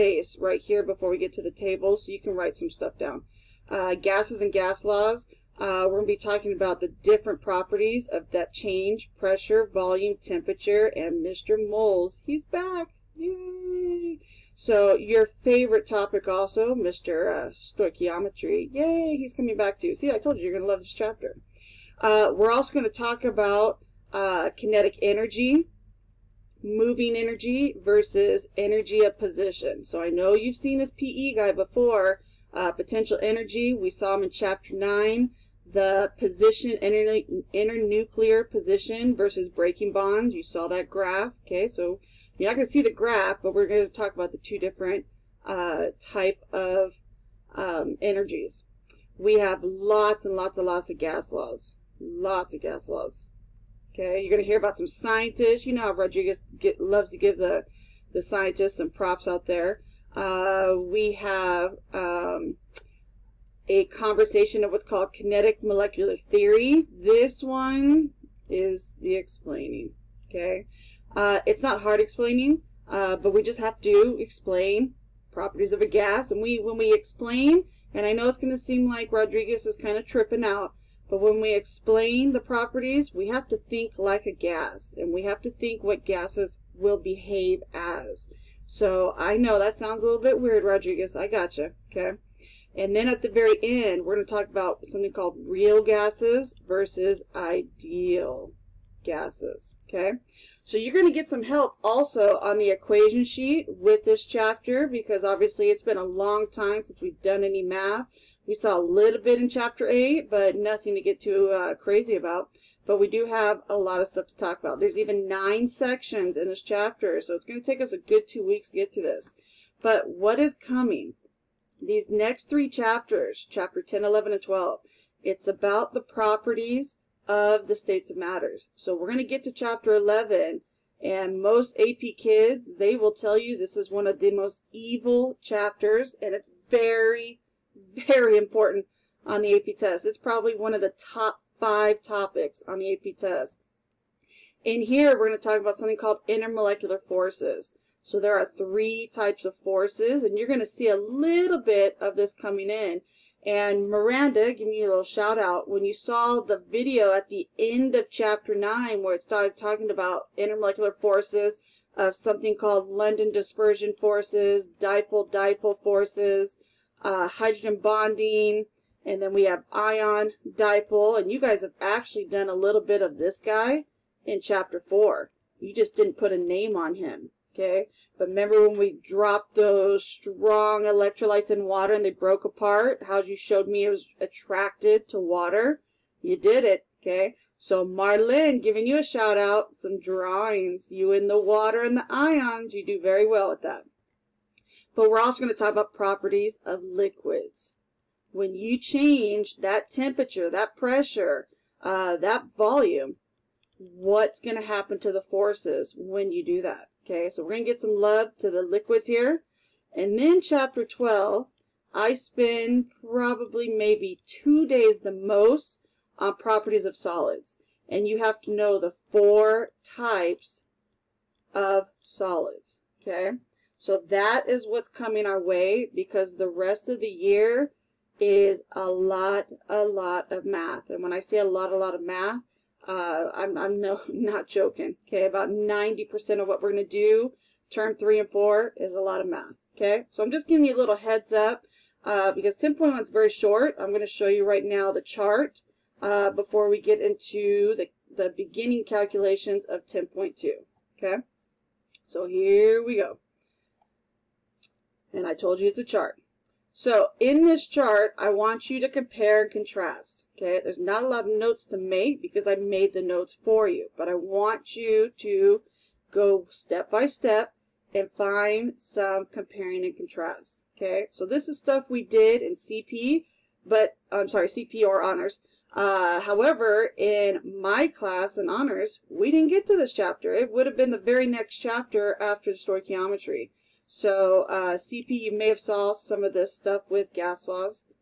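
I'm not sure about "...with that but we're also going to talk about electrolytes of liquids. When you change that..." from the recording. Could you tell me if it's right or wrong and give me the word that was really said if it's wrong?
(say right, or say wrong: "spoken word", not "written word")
wrong: "properties", not "electrolytes".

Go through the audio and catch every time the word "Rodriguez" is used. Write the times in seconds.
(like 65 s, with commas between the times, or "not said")
55 s, 79 s, 90 s.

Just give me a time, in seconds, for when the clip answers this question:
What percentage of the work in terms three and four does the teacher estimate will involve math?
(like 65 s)
235 s.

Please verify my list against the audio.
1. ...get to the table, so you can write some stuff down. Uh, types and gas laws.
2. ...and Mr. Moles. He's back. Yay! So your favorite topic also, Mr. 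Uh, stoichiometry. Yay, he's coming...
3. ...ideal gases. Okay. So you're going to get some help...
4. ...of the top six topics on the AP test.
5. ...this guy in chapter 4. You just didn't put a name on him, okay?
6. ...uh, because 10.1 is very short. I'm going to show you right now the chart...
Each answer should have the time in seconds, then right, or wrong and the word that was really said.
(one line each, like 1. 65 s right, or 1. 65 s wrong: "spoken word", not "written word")
1. 1 s wrong: "gases", not "types"
2. 10 s right
3. 97 s right
4. 140 s wrong: "five", not "six"
5. 173 s right
6. 242 s right.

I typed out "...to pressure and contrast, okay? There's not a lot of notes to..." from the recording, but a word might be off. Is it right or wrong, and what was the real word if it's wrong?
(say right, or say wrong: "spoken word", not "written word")
wrong: "compare", not "pressure".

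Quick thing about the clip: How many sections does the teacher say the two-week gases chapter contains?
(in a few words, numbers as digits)
9.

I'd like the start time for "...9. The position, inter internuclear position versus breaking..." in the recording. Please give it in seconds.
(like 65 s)
34 s.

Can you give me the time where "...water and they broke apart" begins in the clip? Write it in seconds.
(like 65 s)
181 s.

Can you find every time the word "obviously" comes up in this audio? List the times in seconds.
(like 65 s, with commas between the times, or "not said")
105 s.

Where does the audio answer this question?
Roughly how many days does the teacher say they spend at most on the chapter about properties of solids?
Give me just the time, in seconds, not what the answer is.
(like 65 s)
214 s.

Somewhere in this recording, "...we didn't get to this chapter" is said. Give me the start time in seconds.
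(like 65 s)
279 s.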